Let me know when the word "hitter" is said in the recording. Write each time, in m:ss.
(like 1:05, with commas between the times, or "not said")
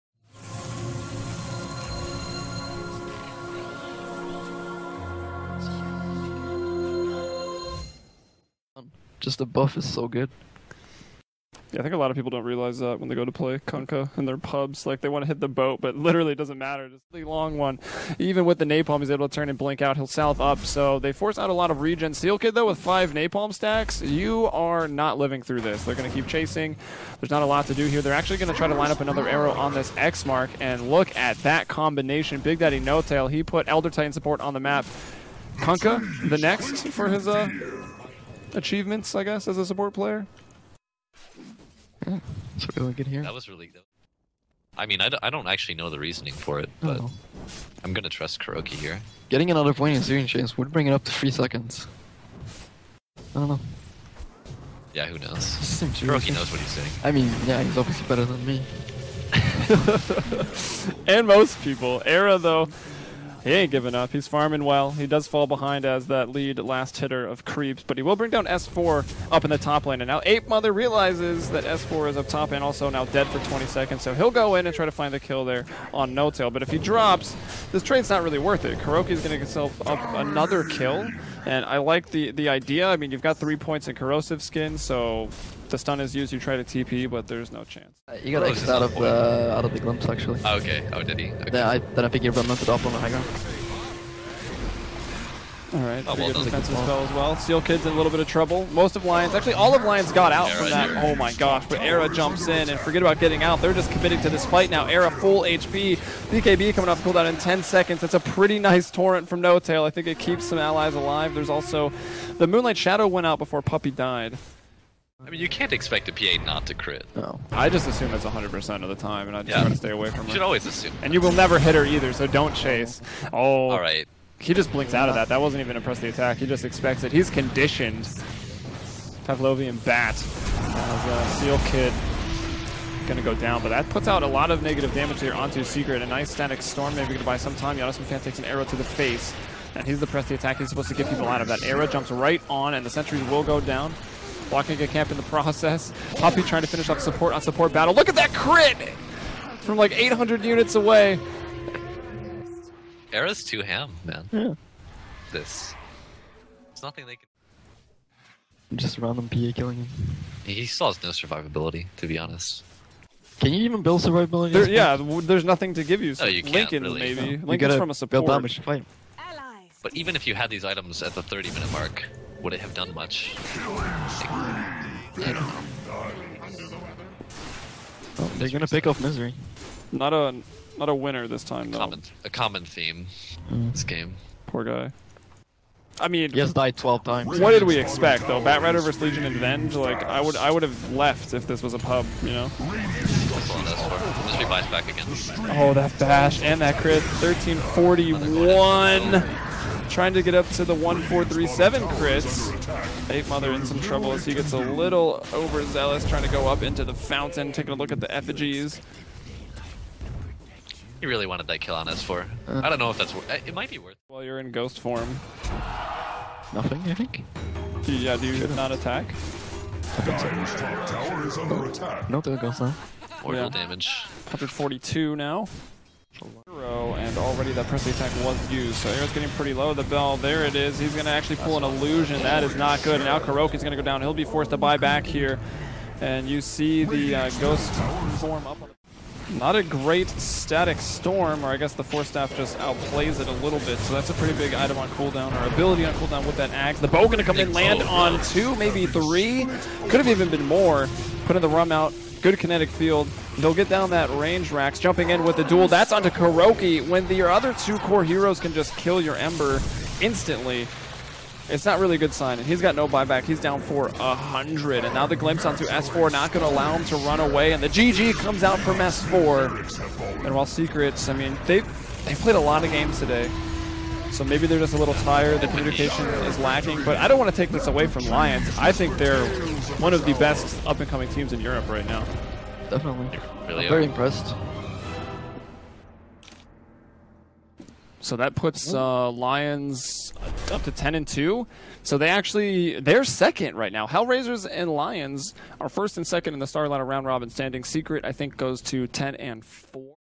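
1:06.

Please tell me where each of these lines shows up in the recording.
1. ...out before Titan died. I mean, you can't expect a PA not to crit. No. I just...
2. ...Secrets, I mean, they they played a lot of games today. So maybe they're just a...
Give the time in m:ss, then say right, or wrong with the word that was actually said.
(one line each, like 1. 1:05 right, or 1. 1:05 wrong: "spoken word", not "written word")
1. 1:53 wrong: "Puppey", not "Titan"
2. 4:30 right.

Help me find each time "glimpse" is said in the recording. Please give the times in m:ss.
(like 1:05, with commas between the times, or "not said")
1:29, 4:25.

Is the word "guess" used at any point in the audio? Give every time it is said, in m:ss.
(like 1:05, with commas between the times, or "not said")
0:39, 4:01.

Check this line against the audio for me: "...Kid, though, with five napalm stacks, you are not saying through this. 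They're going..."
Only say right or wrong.
wrong.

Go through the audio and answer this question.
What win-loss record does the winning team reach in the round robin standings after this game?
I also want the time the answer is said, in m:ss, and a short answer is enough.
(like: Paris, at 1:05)
10 and 2, at 4:50.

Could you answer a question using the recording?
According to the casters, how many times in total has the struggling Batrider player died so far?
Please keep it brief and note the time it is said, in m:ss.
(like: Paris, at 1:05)
12, at 3:06.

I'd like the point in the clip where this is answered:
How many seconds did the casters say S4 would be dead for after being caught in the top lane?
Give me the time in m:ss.
1:13.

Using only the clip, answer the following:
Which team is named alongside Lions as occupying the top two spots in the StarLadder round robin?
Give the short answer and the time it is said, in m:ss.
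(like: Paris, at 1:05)
Hellraisers, at 4:53.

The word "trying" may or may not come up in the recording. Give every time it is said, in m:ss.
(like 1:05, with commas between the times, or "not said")
2:26, 3:19, 3:26.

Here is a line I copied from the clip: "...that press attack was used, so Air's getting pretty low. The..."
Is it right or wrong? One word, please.
right.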